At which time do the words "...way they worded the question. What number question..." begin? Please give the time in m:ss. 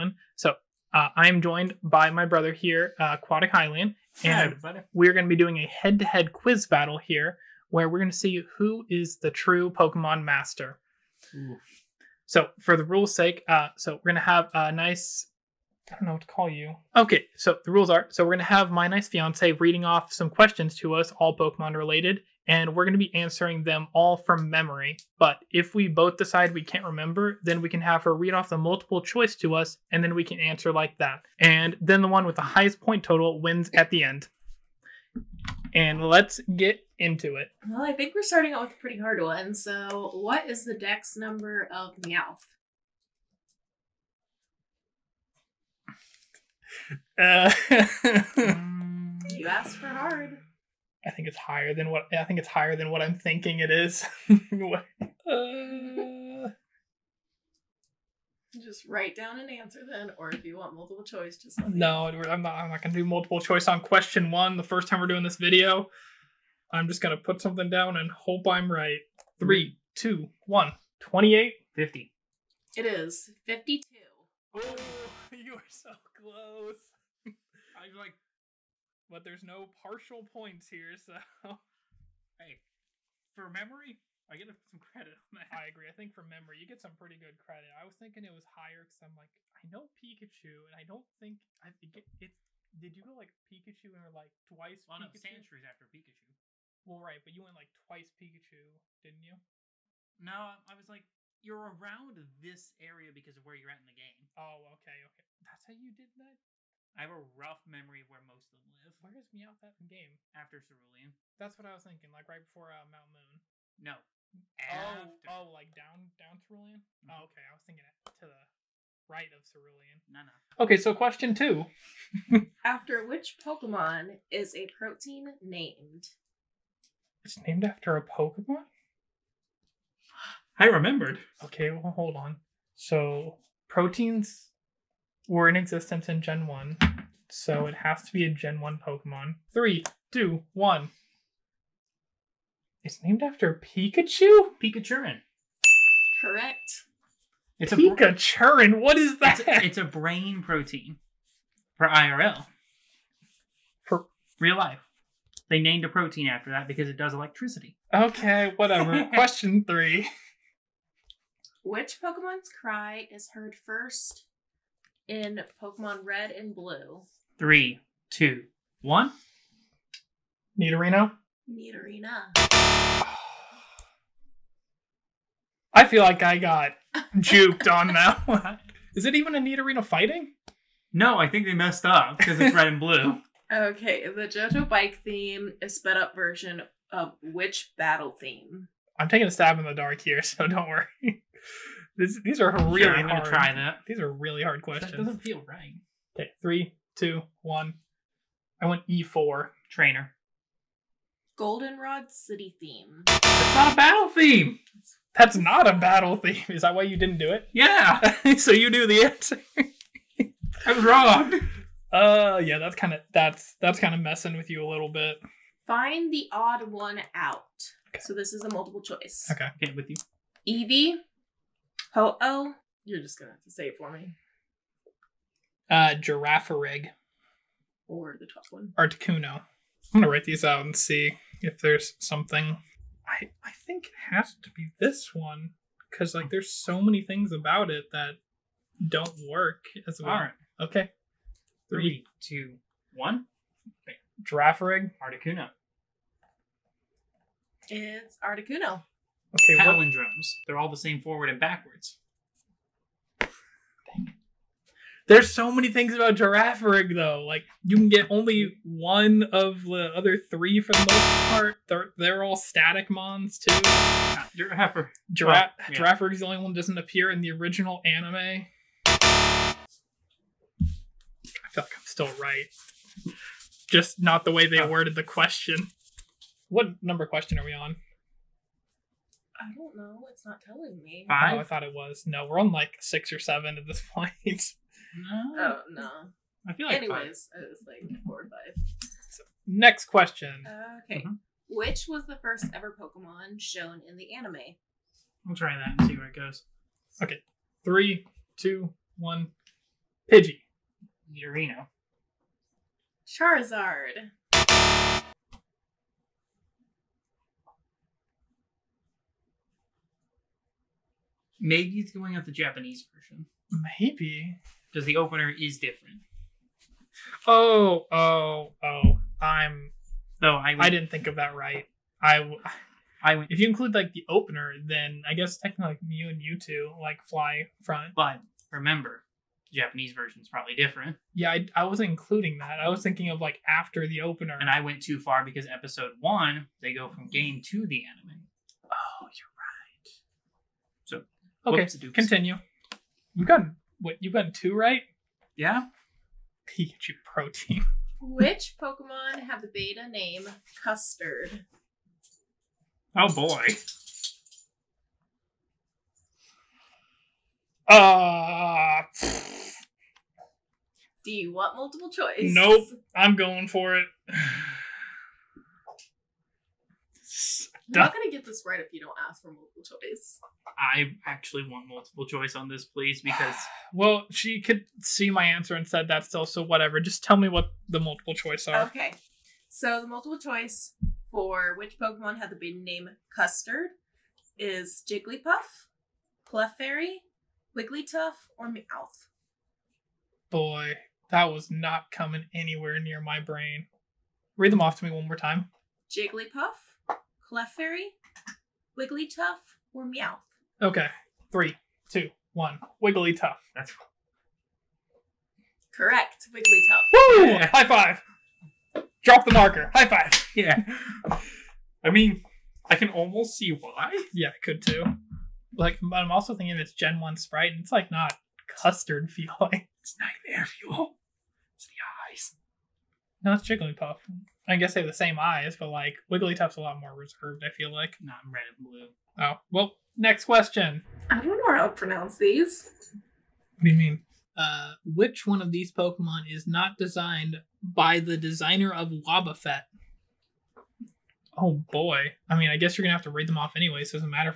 4:34.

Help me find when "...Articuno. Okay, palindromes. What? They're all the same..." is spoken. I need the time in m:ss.
4:08.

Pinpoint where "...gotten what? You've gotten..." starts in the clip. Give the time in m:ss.
5:43.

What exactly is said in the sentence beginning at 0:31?
And then the one with the highest point total wins at the end.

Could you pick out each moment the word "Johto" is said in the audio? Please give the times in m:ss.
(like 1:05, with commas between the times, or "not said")
3:04.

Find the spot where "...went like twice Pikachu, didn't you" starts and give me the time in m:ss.
1:37.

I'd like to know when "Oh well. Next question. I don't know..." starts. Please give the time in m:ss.
7:09.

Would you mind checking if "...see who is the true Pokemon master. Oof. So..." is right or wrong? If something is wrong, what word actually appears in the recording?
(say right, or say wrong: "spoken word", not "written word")
right.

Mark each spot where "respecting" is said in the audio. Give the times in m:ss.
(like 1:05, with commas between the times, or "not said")
not said.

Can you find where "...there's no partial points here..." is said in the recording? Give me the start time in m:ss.
1:19.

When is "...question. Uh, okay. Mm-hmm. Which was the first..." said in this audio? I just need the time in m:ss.
4:49.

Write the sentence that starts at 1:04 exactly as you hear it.
The first time we're doing this video, I'm just gonna put something down and hope I'm right.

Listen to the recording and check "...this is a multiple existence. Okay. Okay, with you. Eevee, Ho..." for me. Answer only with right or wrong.
wrong.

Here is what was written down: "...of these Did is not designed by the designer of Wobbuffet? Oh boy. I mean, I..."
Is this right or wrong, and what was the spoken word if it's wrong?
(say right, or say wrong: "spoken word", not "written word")
wrong: "Pokemon", not "Did".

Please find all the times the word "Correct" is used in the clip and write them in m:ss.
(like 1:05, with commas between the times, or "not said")
2:26, 6:45.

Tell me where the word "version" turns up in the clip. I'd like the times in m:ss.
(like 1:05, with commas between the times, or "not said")
3:06, 5:12, 5:29.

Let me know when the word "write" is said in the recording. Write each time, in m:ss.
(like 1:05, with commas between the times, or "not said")
0:58, 3:50.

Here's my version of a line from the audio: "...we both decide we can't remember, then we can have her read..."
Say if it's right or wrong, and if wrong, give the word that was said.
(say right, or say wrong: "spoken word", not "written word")
right.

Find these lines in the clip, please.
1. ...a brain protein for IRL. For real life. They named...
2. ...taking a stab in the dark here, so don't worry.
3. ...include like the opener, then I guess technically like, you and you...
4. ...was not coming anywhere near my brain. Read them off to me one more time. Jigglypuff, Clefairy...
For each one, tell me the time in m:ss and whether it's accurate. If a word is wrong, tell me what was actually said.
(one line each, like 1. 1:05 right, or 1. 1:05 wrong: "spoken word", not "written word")
1. 2:29 right
2. 3:09 right
3. 5:23 right
4. 6:31 right.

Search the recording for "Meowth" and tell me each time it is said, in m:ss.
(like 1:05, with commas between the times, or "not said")
0:41, 1:49, 6:28, 6:39.